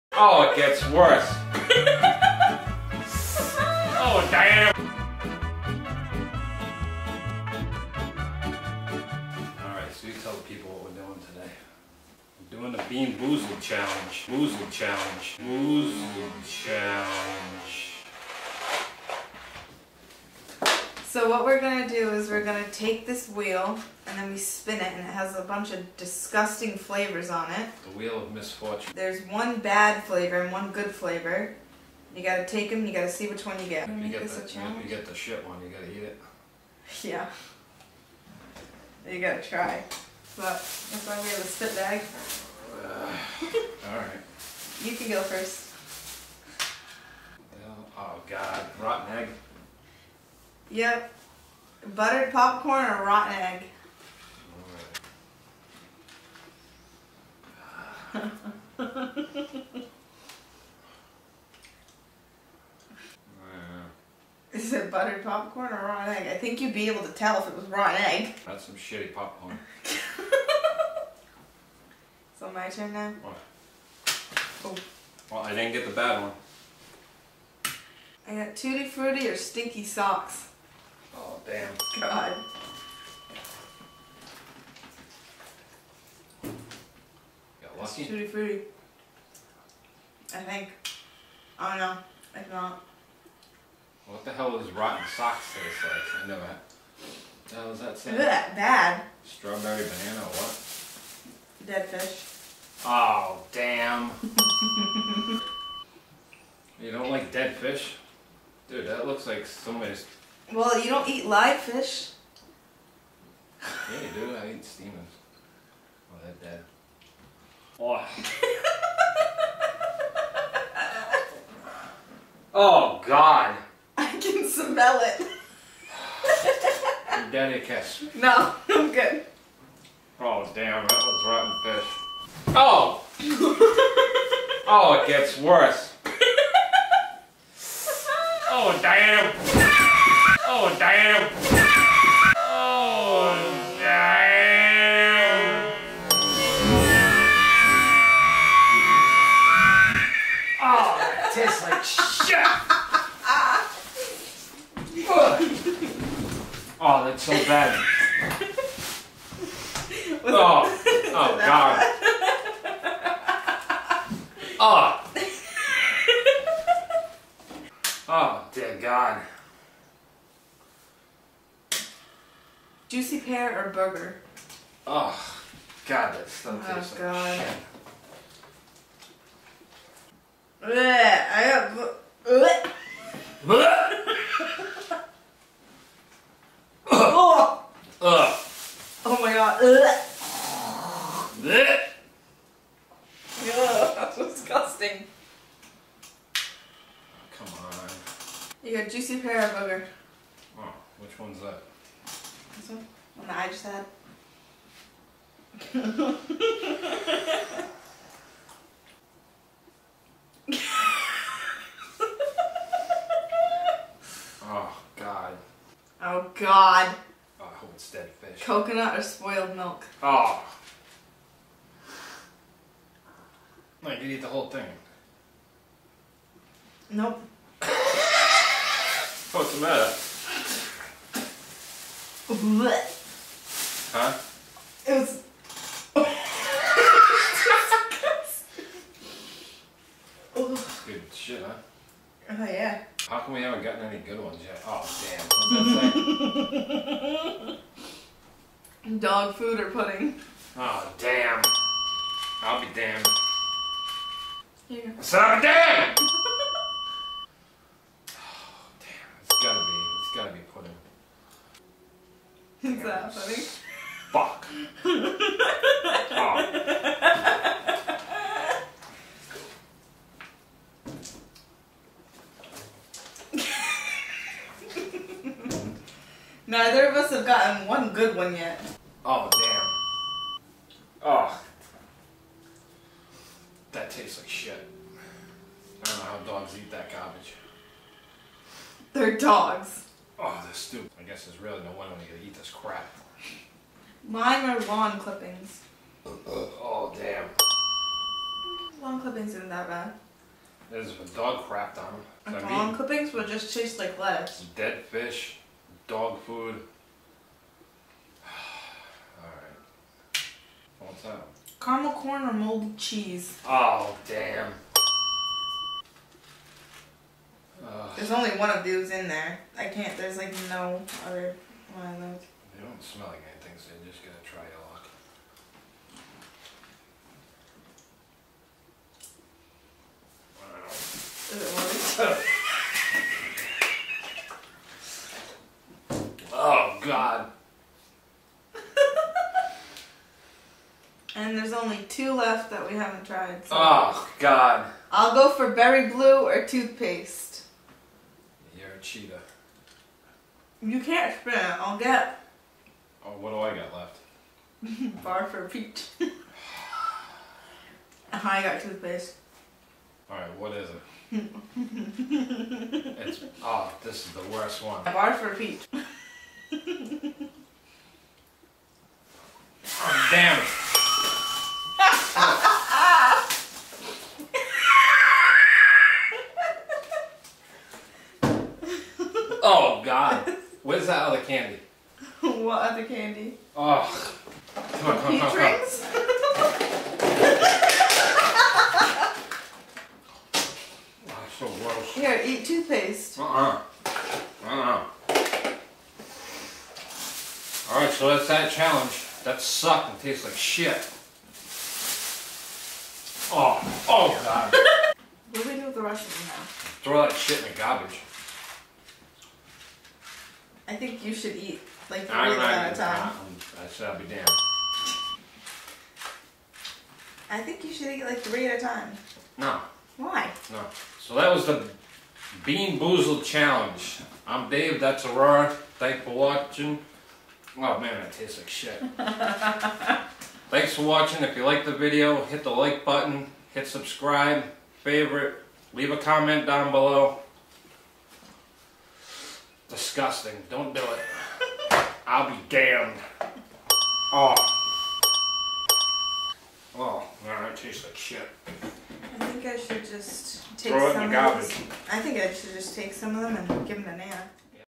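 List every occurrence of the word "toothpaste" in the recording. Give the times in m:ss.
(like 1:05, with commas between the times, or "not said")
5:46, 5:58, 6:32.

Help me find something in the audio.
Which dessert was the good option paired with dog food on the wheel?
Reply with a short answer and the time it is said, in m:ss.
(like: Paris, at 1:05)
Pudding, at 4:09.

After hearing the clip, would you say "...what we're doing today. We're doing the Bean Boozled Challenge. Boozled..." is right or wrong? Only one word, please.
right.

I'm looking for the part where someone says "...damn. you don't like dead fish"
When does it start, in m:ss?
1:43.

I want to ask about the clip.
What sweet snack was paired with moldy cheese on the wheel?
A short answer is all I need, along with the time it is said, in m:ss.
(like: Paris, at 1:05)
Caramel corn, at 5:11.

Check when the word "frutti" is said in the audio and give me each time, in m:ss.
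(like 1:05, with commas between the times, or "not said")
1:18, 1:28.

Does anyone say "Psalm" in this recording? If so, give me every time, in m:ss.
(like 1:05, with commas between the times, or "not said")
not said.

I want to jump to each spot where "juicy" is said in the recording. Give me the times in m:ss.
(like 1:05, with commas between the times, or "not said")
2:52, 3:18.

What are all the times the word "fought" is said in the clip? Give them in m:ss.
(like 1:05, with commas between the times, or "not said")
not said.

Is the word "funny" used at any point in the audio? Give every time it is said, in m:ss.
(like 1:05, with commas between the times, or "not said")
4:23.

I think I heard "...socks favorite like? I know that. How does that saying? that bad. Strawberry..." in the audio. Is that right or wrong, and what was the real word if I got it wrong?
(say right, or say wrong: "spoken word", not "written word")
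wrong: "taste", not "favorite".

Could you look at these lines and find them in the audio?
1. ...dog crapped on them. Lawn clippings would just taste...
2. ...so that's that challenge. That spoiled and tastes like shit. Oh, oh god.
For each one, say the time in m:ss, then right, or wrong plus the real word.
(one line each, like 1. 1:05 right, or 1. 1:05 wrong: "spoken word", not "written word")
1. 5:01 right
2. 6:37 wrong: "sucked", not "spoiled".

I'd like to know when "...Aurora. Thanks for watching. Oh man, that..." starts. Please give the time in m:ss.
7:05.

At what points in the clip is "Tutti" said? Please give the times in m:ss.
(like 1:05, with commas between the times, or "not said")
1:18, 1:28.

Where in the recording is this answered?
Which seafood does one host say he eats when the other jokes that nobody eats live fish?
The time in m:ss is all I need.
1:54.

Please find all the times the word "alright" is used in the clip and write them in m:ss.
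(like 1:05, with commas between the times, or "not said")
0:43, 5:09, 6:00, 6:37, 7:27.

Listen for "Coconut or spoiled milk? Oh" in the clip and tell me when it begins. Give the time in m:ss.
3:38.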